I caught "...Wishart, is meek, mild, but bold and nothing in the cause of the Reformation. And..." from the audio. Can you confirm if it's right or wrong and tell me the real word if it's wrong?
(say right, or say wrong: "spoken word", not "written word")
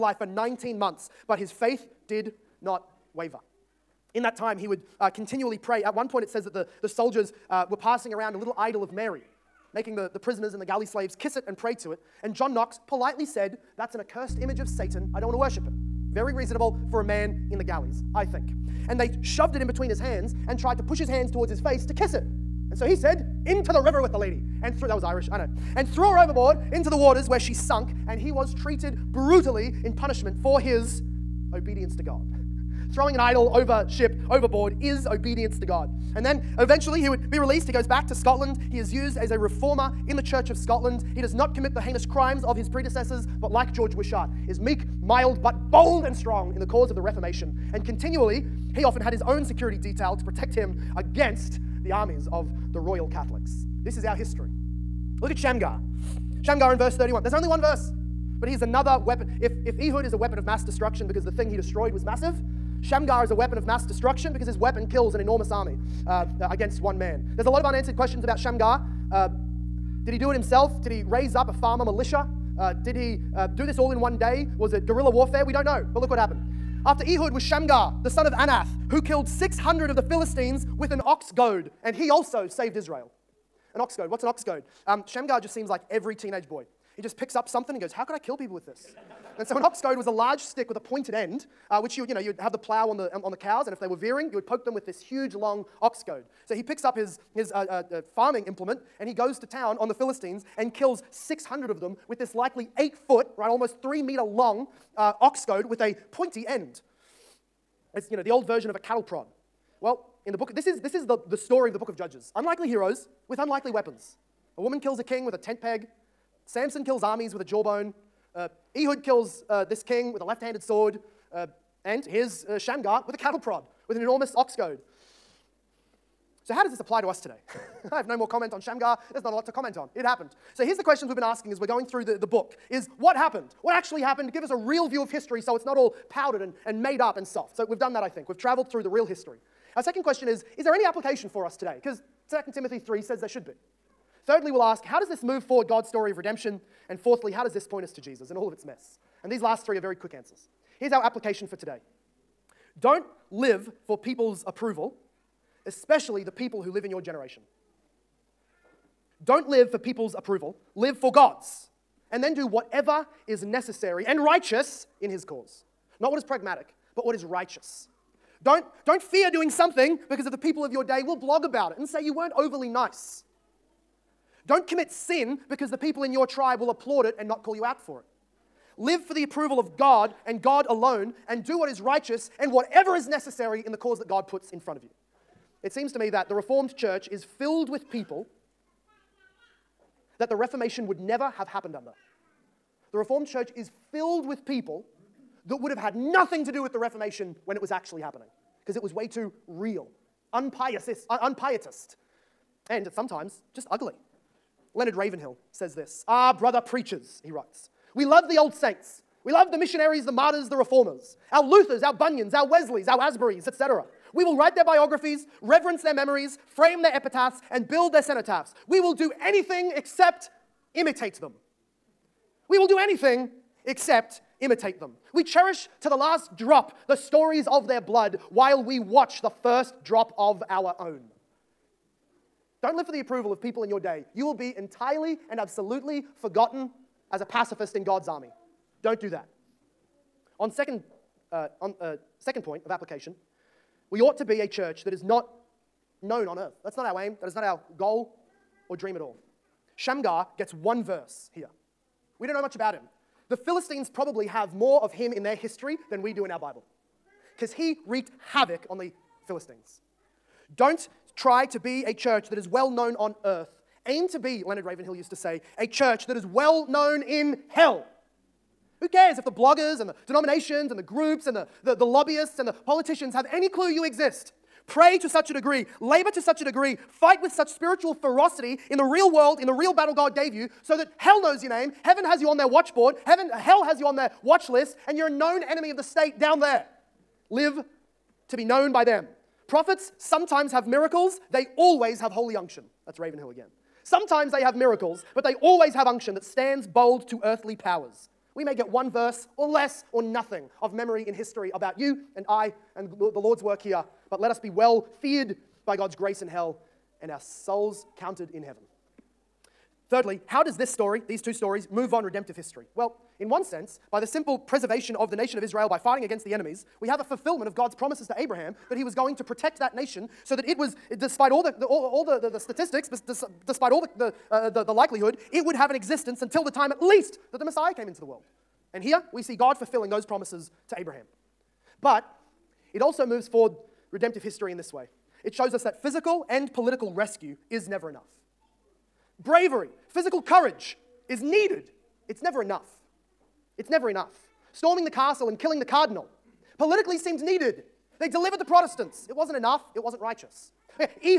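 wrong: "strong", not "nothing".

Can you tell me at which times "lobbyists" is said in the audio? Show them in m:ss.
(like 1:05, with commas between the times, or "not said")
4:31.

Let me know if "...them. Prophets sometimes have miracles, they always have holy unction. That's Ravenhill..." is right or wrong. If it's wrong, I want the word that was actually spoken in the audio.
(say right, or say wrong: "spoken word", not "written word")
right.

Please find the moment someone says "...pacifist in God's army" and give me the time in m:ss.
3:57.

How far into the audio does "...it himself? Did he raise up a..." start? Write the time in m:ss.
1:10.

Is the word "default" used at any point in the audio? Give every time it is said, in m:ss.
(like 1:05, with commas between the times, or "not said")
not said.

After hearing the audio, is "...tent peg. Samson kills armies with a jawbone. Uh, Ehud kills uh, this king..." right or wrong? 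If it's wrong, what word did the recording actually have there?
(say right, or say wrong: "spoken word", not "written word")
right.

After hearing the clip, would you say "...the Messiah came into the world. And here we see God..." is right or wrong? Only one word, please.
right.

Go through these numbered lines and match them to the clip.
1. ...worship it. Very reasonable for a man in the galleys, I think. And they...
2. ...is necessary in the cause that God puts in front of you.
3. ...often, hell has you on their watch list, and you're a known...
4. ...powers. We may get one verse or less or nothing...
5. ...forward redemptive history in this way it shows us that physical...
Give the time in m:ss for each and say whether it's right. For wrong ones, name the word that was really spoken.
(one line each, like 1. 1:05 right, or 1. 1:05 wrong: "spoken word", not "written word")
1. 0:15 right
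2. 3:02 right
3. 4:43 wrong: "heaven", not "often"
4. 4:57 right
5. 5:33 right.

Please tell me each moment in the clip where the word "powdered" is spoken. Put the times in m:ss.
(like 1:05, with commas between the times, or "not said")
2:16.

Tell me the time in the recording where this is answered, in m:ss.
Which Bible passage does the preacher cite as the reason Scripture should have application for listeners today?
2:22.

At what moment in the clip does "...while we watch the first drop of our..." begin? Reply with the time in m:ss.
3:48.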